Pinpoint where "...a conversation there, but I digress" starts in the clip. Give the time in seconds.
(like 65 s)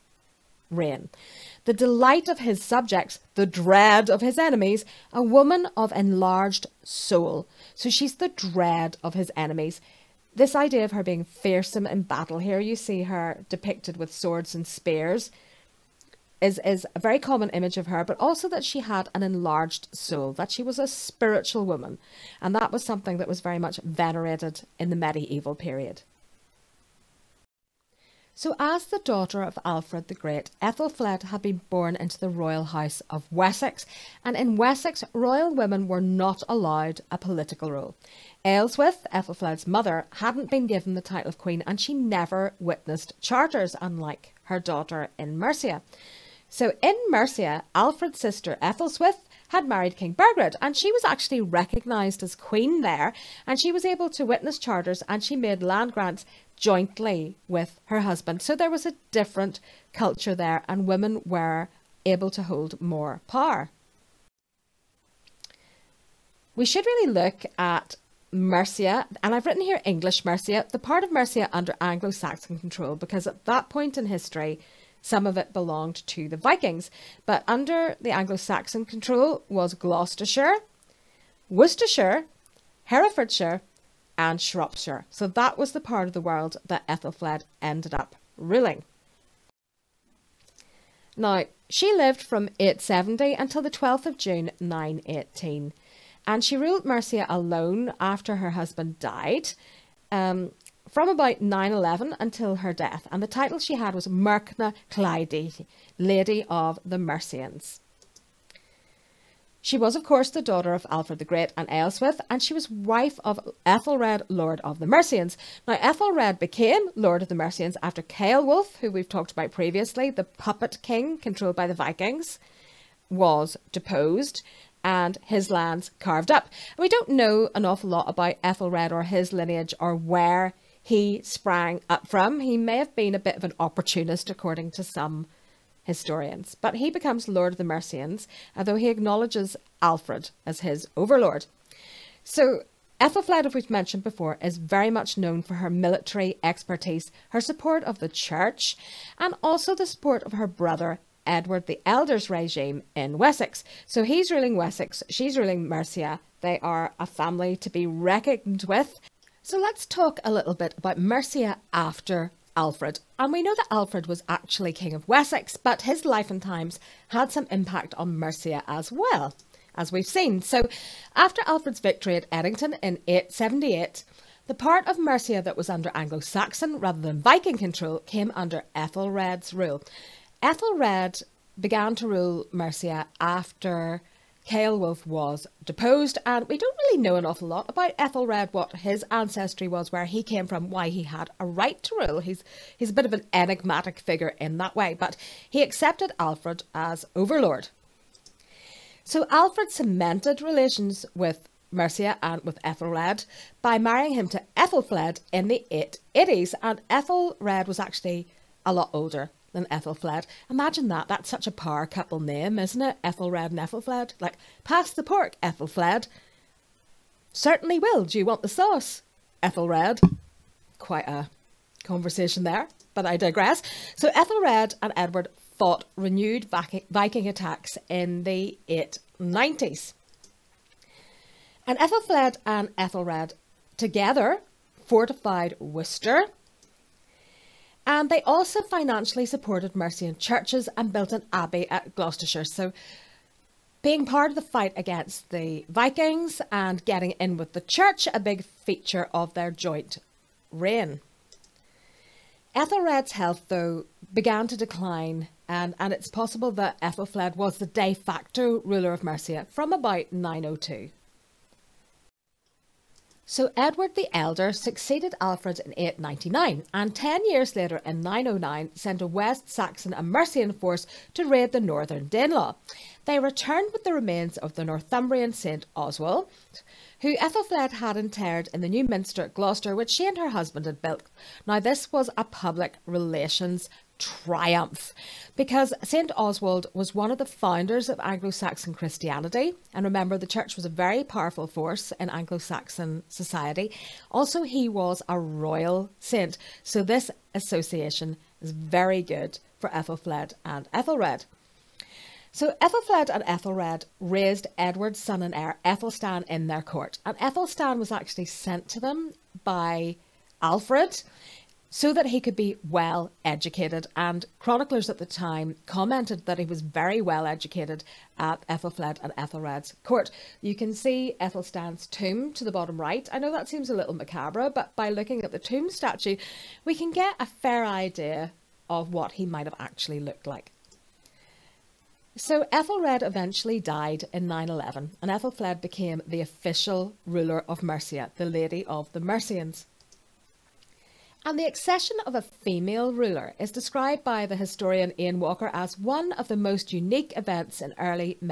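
221 s.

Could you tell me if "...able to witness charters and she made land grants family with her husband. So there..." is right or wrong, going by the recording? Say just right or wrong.
wrong.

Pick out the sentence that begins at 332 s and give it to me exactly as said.
So Ethelred eventually died in 911 and Ethelfled became the official ruler of Mercia, the Lady of the Mercians.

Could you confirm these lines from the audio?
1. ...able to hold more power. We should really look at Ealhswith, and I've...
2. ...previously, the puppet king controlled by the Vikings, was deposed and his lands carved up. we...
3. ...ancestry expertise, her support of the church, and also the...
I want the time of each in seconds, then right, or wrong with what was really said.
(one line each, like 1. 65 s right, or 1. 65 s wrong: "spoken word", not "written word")
1. 62 s wrong: "Mercia", not "Ealhswith"
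2. 119 s right
3. 145 s wrong: "military", not "ancestry".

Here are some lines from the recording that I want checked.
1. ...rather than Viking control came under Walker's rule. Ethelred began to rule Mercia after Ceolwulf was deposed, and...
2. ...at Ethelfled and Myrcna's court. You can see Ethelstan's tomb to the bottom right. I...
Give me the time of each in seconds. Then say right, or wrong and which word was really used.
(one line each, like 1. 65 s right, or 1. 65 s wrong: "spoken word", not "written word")
1. 176 s wrong: "Ethelred", not "Walker"
2. 318 s wrong: "Ethelred", not "Myrcna".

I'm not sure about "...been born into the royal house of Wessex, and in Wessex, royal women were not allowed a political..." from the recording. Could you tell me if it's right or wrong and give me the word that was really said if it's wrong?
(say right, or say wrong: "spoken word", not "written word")
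right.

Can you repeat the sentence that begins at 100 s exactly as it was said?
Um, from about 9-11 until her death, and the title she had was Myrcna hlæfdige, Lady of the Mercians.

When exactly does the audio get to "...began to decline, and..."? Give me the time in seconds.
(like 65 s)
254 s.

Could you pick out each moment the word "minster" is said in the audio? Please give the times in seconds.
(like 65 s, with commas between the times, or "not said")
278 s.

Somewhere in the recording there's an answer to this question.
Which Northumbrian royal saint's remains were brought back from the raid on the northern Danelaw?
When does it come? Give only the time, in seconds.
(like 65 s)
275 s.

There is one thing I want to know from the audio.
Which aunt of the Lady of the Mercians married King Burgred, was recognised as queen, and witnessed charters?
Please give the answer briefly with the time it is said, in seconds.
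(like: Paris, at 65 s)
Ethelswith, at 48 s.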